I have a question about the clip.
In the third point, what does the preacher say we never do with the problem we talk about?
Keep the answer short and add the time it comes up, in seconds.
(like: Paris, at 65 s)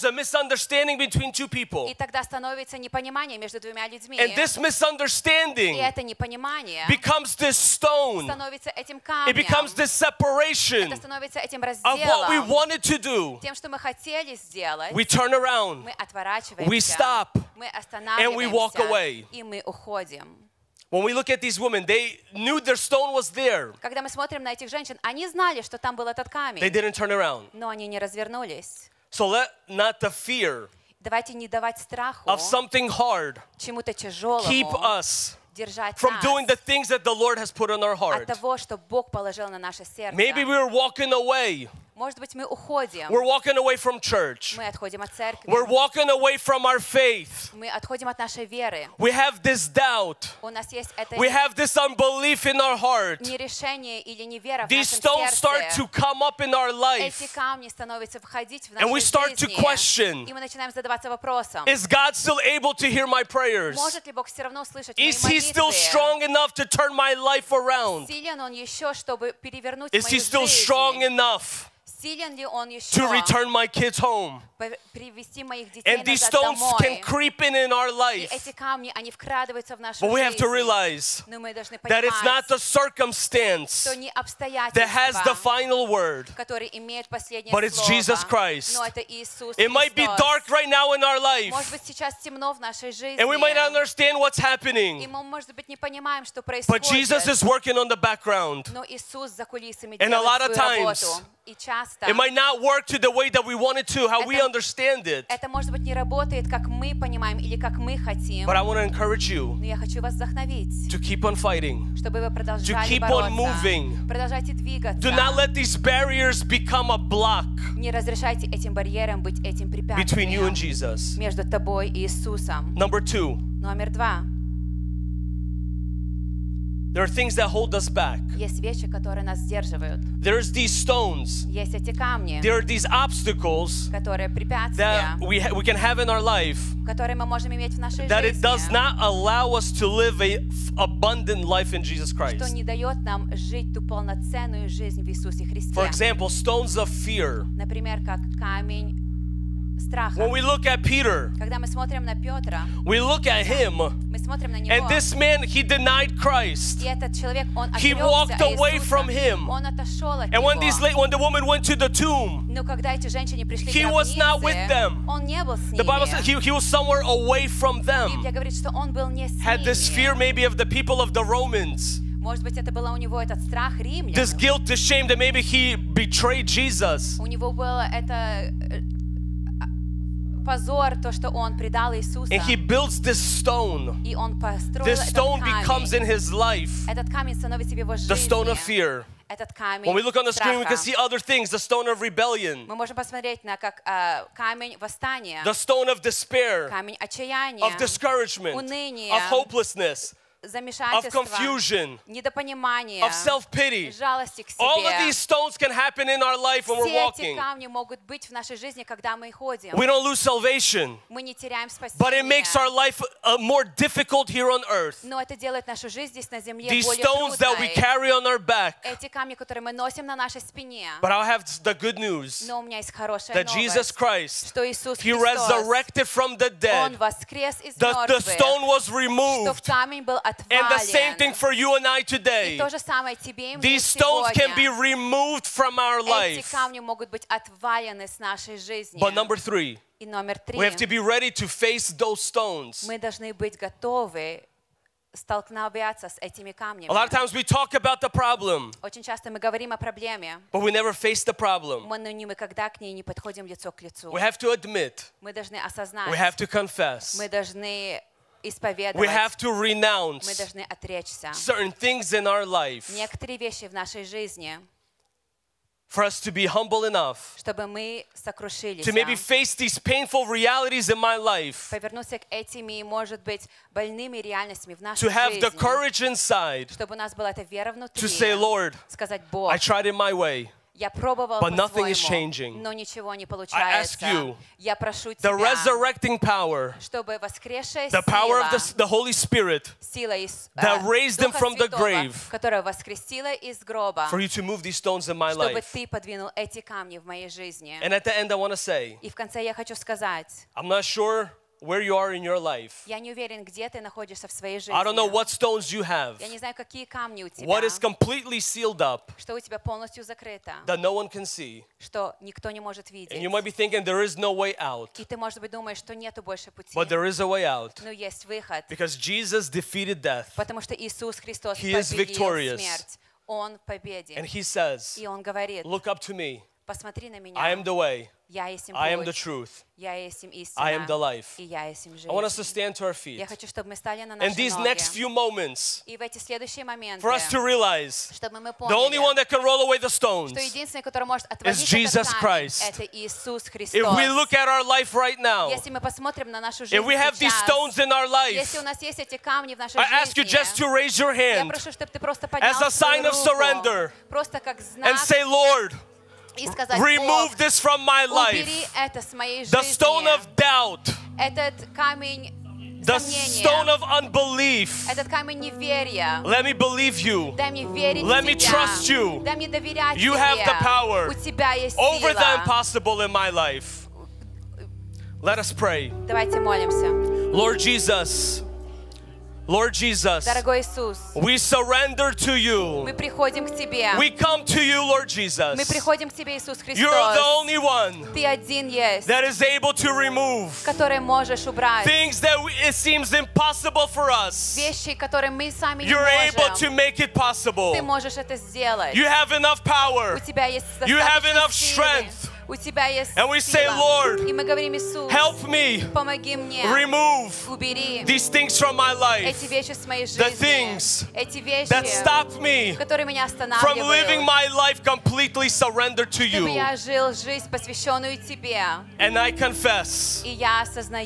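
Face the problem, at 250 s.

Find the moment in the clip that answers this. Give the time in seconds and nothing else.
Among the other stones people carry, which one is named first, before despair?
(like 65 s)
191 s.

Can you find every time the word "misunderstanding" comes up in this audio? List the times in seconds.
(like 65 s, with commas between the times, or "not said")
0 s, 4 s.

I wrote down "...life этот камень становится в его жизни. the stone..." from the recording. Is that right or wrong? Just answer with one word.
right.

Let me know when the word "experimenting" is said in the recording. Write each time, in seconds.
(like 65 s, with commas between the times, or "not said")
not said.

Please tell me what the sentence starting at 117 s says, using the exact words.
Не разрешайте этим барьерам быть этим препятствием.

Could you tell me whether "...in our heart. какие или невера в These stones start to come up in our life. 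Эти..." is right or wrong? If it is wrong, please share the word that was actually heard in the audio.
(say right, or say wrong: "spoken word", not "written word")
wrong: "нерешение", not "какие".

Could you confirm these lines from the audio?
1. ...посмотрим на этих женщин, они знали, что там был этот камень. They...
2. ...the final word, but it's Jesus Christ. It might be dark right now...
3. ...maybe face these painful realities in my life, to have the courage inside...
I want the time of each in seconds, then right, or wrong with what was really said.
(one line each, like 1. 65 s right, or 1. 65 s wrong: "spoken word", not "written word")
1. 24 s wrong: "смотрим", not "посмотрим"
2. 85 s right
3. 268 s right.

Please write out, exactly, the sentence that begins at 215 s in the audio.
These stones that we carry on our back.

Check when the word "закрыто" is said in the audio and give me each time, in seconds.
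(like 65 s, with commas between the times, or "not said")
310 s.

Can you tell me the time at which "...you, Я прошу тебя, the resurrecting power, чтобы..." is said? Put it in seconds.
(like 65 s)
284 s.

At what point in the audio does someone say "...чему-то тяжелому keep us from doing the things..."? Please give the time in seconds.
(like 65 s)
33 s.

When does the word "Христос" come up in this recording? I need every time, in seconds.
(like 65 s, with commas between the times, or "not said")
321 s, 343 s.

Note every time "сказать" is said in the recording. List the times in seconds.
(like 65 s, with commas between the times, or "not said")
299 s, 356 s.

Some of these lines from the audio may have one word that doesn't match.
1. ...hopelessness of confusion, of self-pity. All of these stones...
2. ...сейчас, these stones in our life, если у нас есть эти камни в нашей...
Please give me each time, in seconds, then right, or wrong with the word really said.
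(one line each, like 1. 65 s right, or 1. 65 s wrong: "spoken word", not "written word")
1. 199 s right
2. 347 s right.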